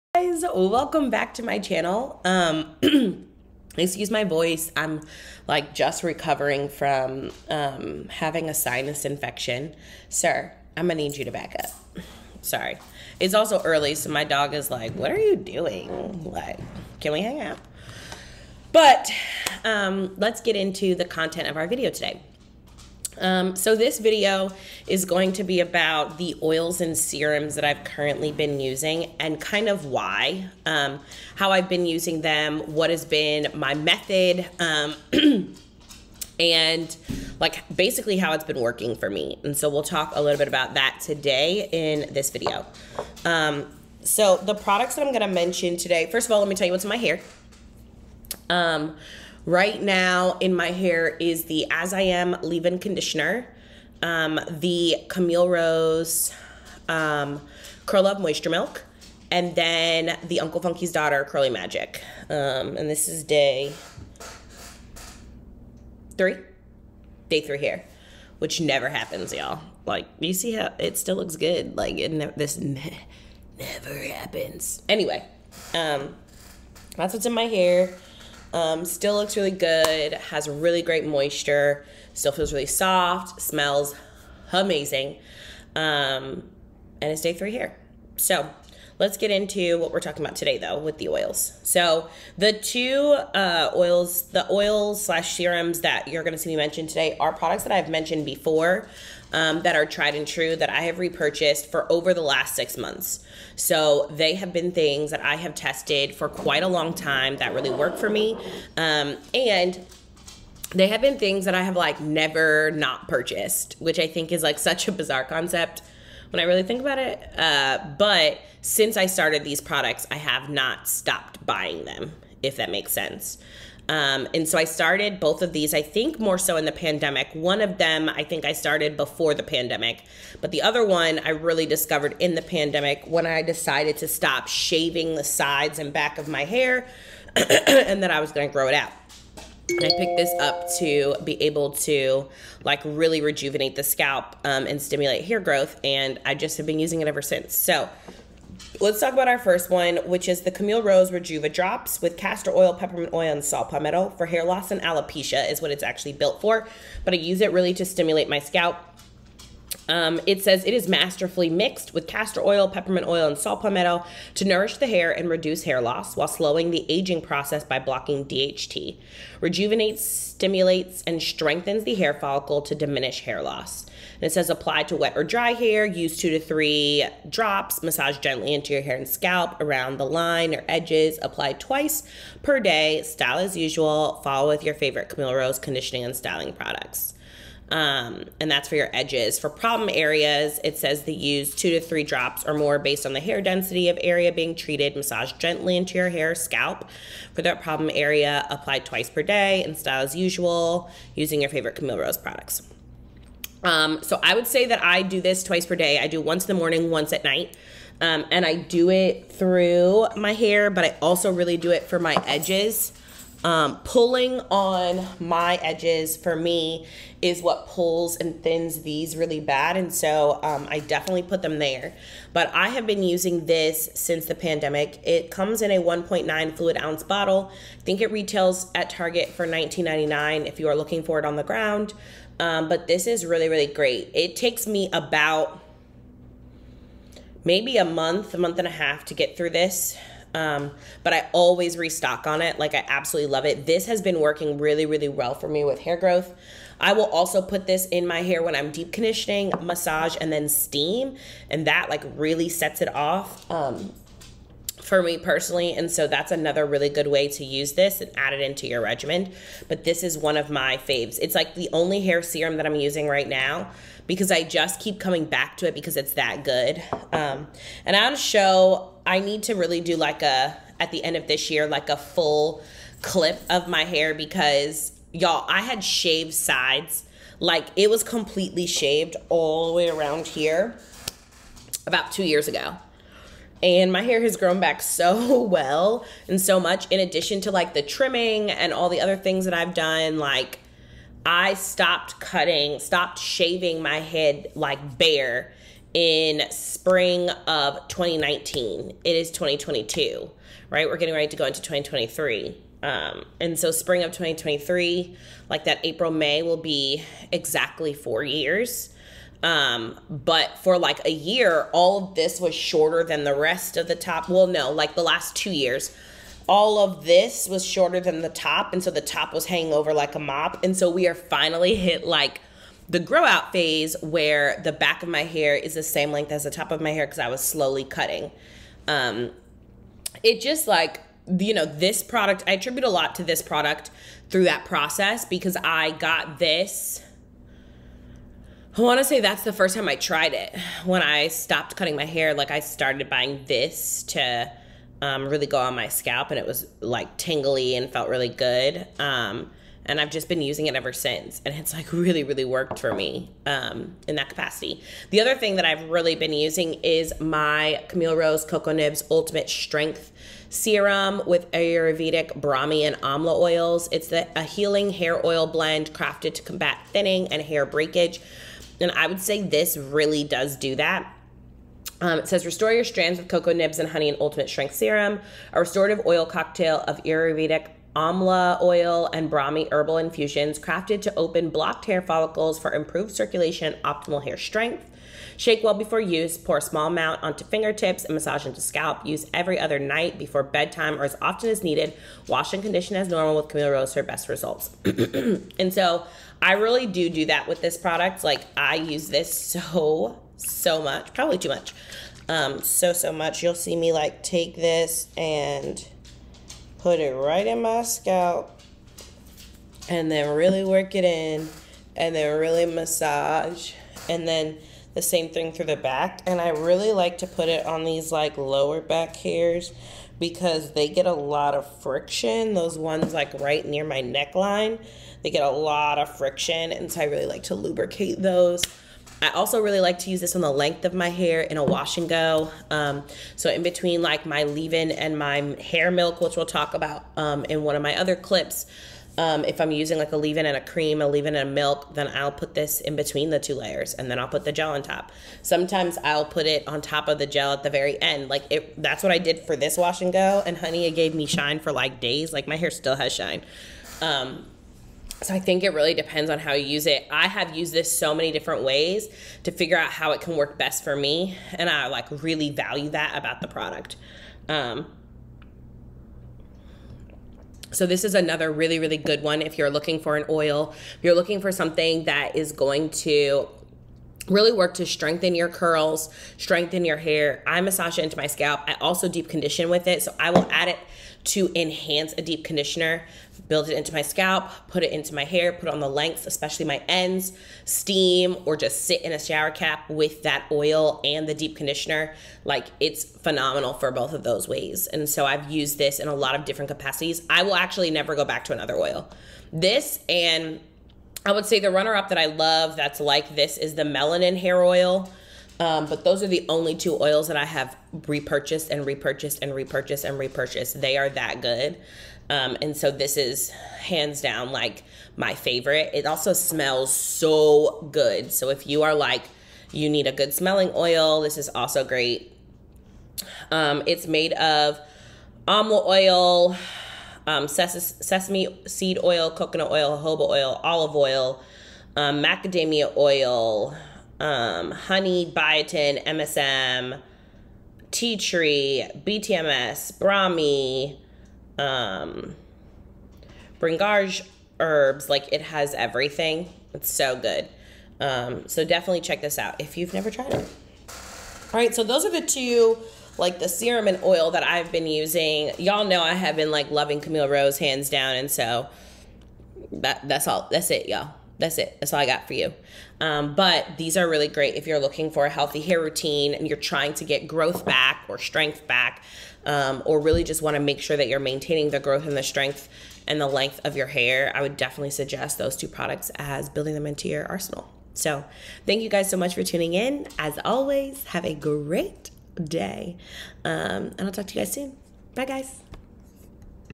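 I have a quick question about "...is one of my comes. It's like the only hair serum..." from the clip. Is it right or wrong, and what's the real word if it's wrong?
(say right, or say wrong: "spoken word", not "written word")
wrong: "faves", not "comes".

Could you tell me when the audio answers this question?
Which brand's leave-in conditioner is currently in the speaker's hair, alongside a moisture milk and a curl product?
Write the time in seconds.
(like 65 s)
51 s.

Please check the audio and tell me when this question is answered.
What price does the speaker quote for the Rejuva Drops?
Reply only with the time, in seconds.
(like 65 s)
229 s.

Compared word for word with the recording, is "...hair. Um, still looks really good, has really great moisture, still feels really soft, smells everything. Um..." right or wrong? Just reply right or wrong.
wrong.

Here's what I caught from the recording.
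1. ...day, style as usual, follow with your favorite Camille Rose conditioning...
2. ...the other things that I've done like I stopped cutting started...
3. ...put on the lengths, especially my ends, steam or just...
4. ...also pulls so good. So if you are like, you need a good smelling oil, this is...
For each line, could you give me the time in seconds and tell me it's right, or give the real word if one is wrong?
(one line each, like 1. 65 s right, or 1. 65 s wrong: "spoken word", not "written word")
1. 182 s right
2. 288 s wrong: "stopped", not "started"
3. 485 s right
4. 516 s wrong: "smells", not "pulls".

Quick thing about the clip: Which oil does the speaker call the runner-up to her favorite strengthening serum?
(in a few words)
melanin hair oil.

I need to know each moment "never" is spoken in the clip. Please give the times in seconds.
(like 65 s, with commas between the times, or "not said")
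68 s, 73 s, 111 s, 497 s, 549 s.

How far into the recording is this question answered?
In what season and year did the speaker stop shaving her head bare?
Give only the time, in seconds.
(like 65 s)
296 s.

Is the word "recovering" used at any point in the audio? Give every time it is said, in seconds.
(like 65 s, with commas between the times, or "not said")
6 s.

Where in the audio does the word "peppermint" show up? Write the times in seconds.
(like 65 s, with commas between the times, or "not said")
152 s, 162 s.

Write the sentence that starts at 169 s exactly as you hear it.
Rejuvenates, stimulates, and strengthens the hair follicle to diminish hair loss.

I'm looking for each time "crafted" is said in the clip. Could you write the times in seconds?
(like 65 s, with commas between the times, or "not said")
365 s, 380 s.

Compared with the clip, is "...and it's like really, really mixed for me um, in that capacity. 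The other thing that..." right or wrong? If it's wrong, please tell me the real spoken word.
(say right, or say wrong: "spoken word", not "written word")
wrong: "worked", not "mixed".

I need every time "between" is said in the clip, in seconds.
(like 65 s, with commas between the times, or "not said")
433 s, 442 s.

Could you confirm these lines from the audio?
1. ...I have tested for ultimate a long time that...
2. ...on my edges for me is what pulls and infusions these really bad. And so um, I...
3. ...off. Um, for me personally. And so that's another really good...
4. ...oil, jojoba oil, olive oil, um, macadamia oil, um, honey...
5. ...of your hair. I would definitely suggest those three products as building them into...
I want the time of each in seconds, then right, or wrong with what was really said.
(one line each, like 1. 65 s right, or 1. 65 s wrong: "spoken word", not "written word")
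1. 105 s wrong: "quite", not "ultimate"
2. 214 s wrong: "thins", not "infusions"
3. 252 s right
4. 529 s right
5. 573 s wrong: "two", not "three".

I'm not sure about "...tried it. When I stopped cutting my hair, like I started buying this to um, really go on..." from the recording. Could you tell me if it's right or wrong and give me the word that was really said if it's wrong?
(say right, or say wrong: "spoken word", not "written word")
right.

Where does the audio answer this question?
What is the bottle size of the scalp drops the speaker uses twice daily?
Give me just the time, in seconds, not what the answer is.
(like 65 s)
225 s.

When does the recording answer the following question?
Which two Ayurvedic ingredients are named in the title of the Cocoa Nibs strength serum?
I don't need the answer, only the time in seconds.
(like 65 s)
362 s.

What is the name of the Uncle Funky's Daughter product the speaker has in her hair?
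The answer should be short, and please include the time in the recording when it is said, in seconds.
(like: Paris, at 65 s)
Curly Magic, at 61 s.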